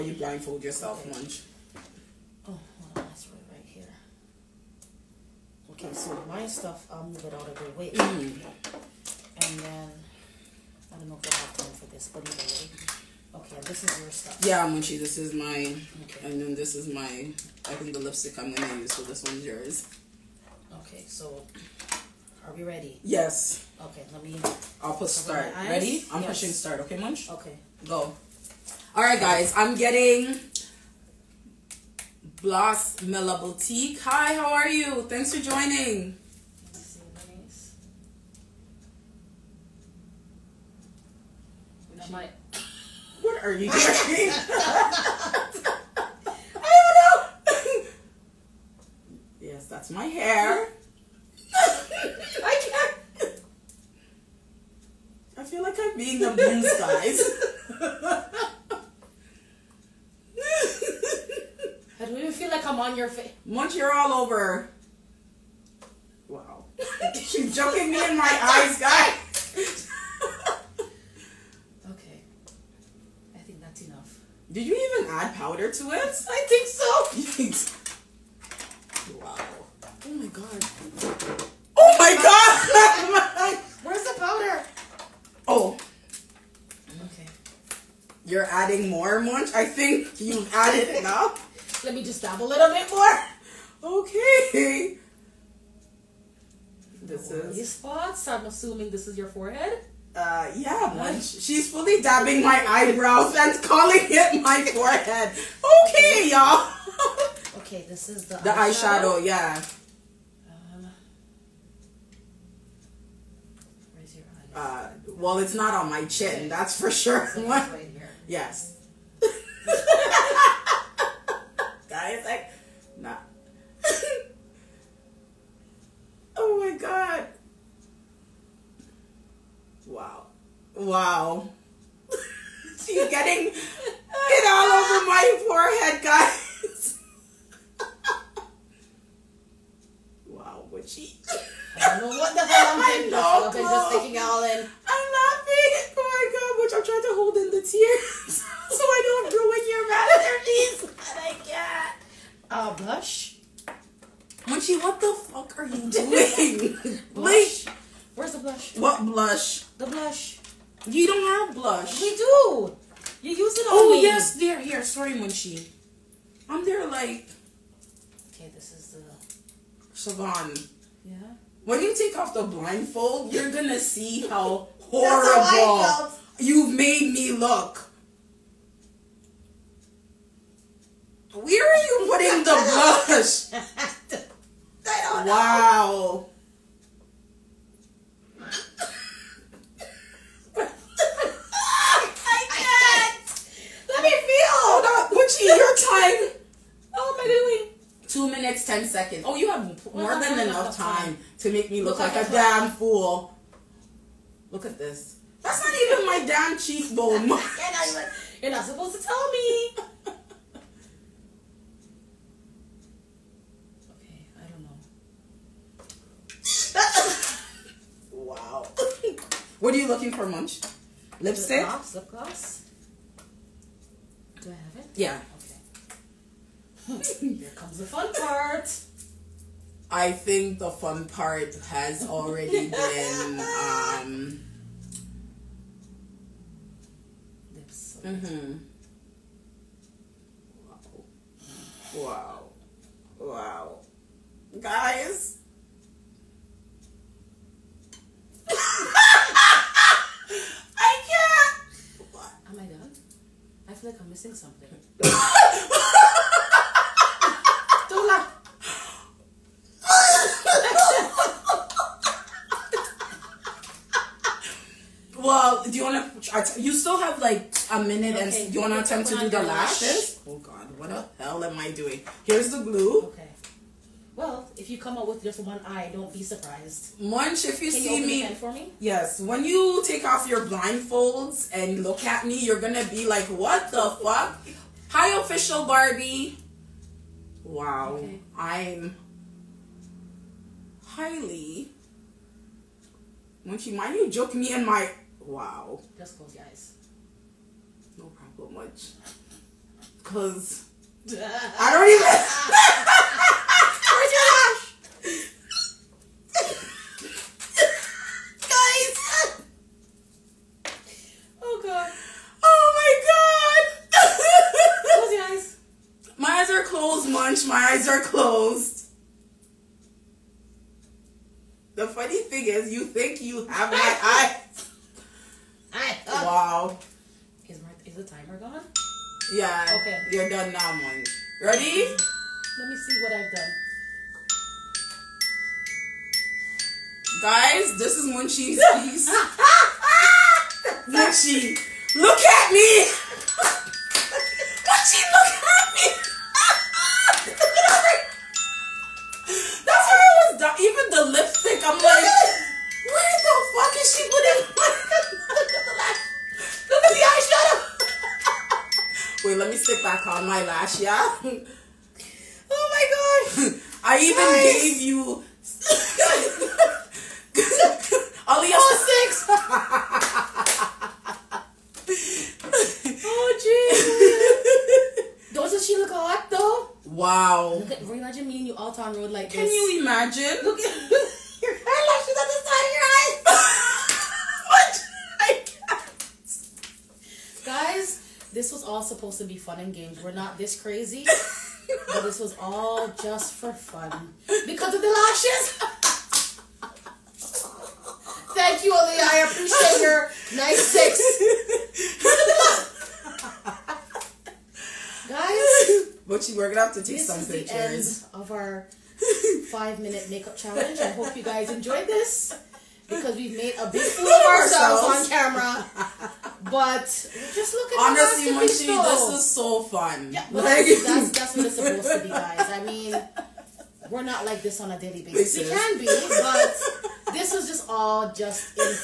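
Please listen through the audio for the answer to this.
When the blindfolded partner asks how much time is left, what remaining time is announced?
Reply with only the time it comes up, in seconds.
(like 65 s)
198 s.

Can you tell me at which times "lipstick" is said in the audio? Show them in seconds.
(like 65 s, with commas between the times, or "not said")
17 s, 221 s, 351 s.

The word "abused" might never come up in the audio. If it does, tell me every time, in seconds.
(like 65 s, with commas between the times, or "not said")
56 s.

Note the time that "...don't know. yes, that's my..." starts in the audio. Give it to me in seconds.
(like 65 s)
45 s.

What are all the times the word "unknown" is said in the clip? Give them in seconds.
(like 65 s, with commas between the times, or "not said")
not said.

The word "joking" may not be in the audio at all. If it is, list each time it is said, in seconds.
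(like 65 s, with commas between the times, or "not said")
67 s.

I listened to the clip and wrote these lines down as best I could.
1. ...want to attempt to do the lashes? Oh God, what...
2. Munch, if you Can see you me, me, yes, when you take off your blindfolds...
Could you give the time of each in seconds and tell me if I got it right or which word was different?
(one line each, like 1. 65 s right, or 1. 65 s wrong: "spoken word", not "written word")
1. 268 s right
2. 277 s right.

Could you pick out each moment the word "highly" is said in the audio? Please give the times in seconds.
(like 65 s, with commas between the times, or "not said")
290 s.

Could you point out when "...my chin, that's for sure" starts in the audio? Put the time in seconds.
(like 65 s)
115 s.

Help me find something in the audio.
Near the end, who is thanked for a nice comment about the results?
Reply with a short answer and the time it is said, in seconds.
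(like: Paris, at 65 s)
Ali, at 398 s.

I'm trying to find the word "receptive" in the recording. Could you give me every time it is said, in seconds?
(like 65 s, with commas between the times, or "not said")
not said.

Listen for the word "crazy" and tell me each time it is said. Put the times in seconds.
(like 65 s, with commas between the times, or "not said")
390 s.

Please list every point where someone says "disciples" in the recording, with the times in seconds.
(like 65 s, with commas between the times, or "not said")
not said.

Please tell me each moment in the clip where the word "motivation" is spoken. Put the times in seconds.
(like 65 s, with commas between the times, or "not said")
not said.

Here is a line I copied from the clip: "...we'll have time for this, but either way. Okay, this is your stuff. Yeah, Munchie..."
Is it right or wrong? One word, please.
right.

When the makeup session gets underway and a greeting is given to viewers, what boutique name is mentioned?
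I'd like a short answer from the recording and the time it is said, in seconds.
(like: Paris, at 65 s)
Bloss Mela Boutique, at 32 s.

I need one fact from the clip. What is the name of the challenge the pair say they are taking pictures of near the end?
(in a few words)
five minute makeup challenge.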